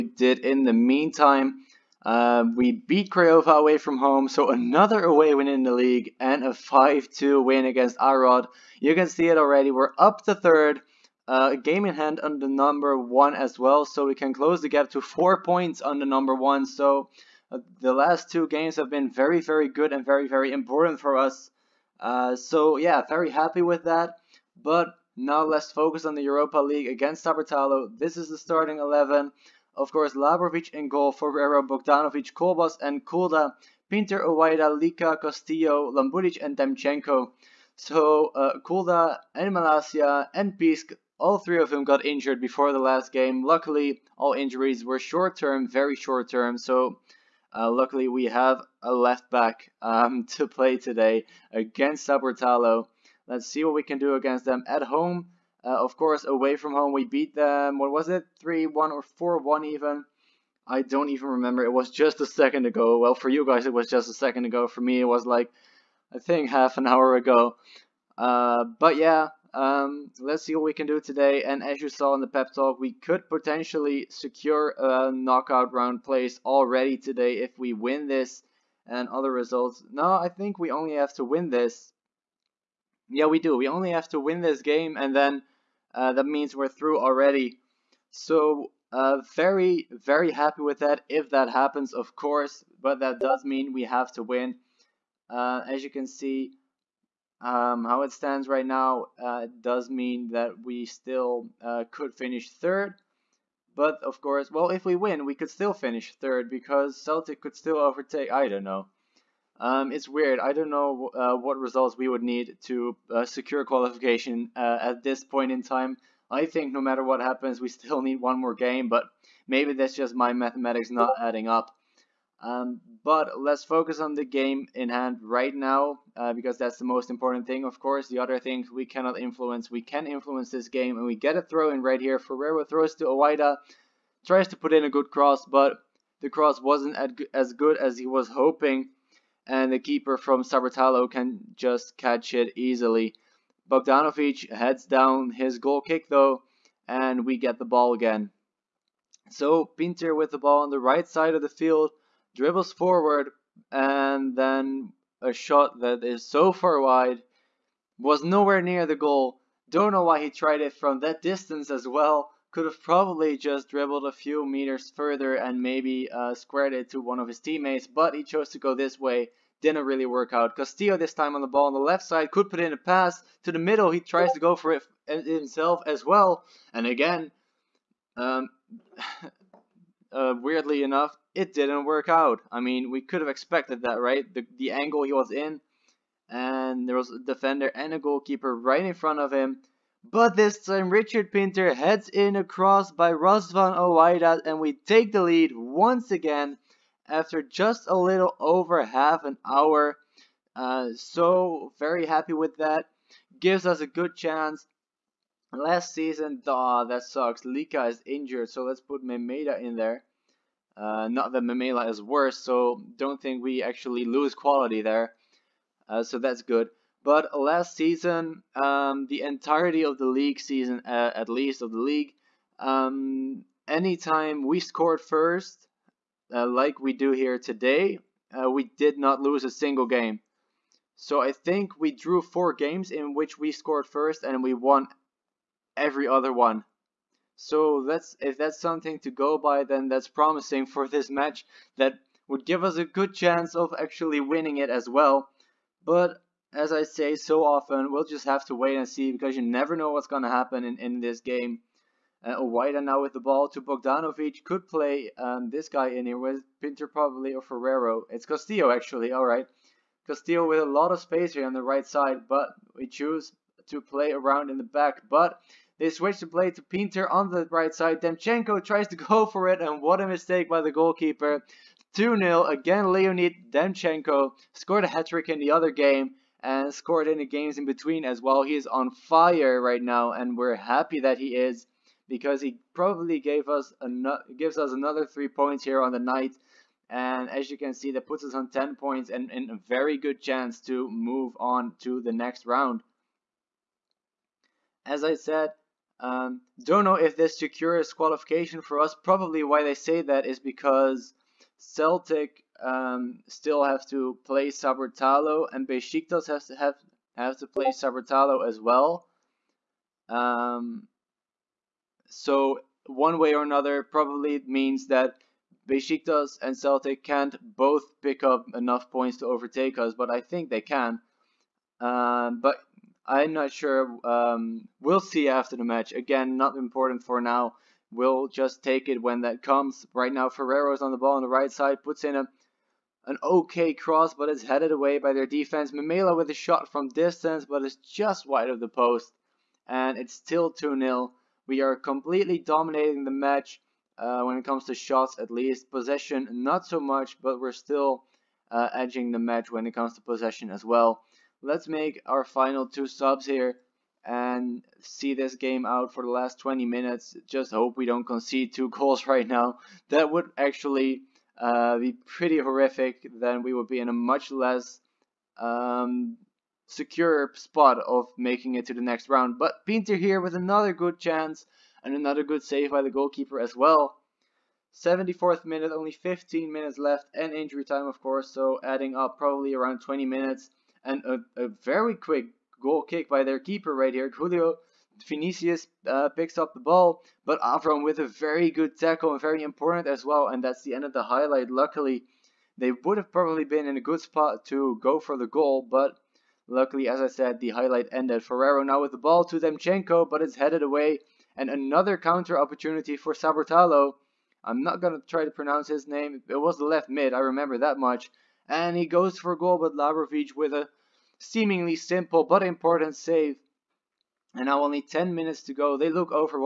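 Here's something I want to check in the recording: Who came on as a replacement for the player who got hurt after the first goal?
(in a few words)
Memeda.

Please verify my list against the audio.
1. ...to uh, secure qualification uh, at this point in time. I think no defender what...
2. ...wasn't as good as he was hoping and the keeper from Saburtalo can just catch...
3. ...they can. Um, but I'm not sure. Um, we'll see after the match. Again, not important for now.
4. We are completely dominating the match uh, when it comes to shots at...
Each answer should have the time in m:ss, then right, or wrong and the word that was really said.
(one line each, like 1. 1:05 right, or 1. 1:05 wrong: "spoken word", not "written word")
1. 1:52 wrong: "matter", not "defender"
2. 2:16 right
3. 5:20 right
4. 5:41 right.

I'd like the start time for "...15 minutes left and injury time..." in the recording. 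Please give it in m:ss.
6:15.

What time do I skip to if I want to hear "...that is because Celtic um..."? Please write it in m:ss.
5:00.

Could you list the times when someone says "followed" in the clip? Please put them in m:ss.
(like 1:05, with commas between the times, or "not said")
not said.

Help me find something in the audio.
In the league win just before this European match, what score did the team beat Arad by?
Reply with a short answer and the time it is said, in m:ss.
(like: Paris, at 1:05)
5-2, at 0:06.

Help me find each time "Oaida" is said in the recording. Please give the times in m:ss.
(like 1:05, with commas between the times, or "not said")
2:13, 3:13, 4:12.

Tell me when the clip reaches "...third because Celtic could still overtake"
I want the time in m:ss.
1:46.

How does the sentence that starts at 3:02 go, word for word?
I mean, we could have expected that, right?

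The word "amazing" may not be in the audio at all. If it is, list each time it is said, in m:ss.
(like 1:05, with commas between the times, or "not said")
not said.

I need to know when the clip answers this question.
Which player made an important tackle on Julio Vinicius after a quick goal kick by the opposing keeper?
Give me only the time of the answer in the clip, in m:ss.
6:27.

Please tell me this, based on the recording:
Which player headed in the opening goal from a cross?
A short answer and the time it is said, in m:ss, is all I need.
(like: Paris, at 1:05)
Richard Pinter, at 3:10.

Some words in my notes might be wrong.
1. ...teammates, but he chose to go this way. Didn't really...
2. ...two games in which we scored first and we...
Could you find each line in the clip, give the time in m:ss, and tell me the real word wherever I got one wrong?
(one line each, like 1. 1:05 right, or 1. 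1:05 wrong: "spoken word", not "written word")
1. 2:47 right
2. 3:52 wrong: "four", not "two".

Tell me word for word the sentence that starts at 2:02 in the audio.
Um, but let's focus on the game in hand right now, uh, because that's the most important thing, of course.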